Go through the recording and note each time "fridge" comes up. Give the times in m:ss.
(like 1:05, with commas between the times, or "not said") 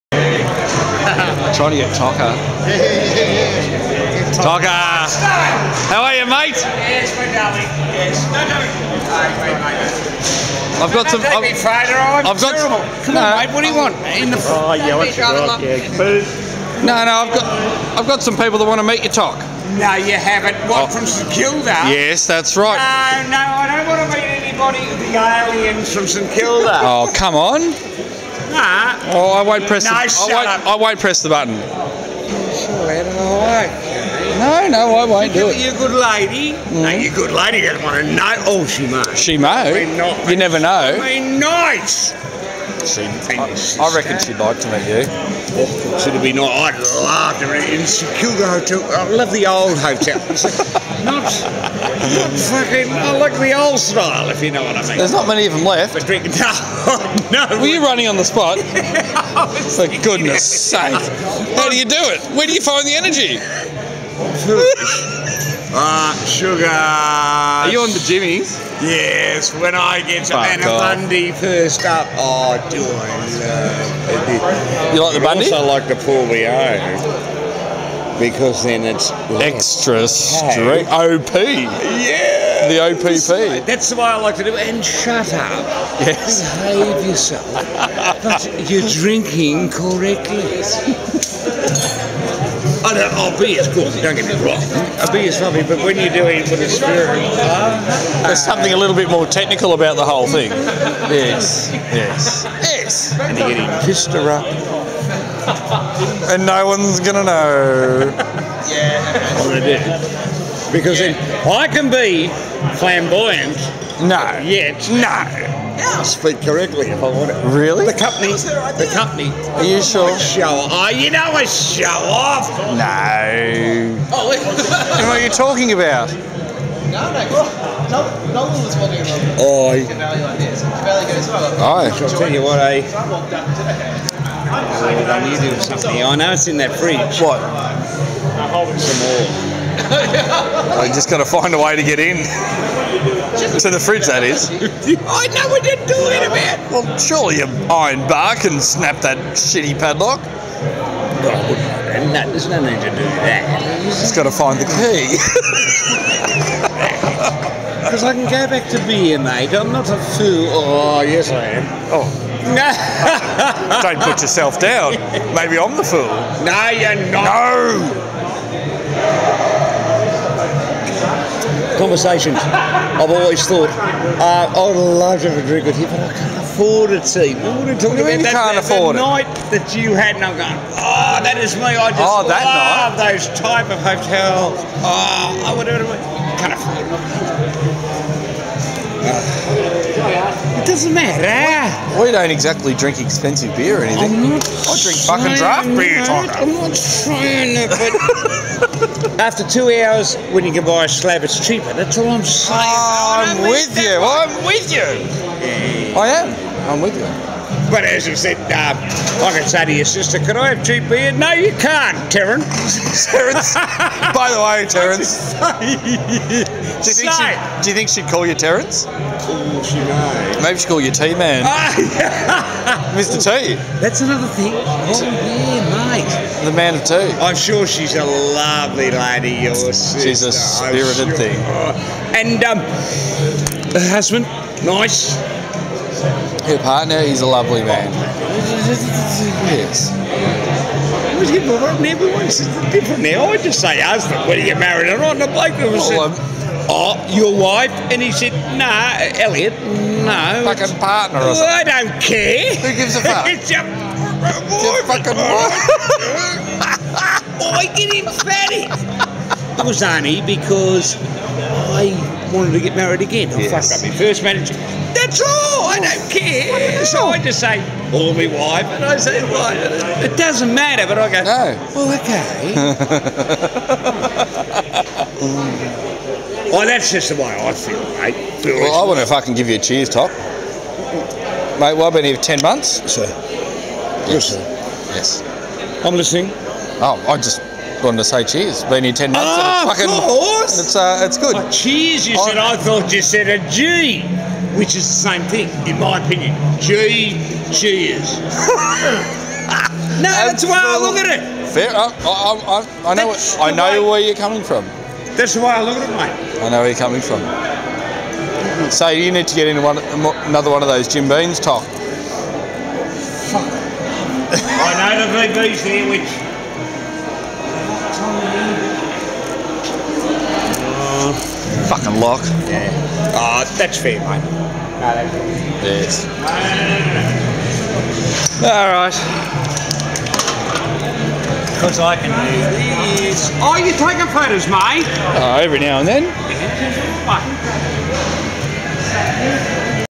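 2:16, 2:23.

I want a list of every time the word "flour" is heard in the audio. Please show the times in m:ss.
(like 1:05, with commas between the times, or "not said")
not said.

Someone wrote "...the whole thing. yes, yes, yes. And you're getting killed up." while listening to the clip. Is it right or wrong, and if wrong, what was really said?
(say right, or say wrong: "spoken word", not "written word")
wrong: "pissed", not "killed".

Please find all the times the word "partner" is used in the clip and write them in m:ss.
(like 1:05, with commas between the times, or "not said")
3:56, 4:10.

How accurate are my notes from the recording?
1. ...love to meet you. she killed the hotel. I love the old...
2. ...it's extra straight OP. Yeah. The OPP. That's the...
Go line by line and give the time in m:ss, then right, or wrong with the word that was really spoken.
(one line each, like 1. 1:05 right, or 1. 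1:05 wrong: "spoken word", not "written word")
1. 0:47 right
2. 1:18 right.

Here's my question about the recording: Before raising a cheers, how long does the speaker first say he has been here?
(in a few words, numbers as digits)
10 months.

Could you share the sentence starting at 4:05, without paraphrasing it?
And the bloke was well, oh, said, oh, your wife?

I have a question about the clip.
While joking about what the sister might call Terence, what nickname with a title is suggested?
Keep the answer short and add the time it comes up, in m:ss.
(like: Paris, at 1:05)
Mr. T, at 3:42.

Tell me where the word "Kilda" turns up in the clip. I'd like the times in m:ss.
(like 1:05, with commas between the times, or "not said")
0:21, 0:26.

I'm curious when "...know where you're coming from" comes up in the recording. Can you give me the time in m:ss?
5:06.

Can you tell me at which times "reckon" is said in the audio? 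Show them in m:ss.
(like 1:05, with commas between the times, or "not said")
0:43.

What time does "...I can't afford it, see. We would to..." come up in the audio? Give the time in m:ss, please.
2:55.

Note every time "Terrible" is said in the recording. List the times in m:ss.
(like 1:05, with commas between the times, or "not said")
0:12.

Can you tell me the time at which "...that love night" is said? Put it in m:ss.
3:02.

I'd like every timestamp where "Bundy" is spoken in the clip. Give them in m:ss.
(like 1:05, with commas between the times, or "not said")
1:10, 1:15.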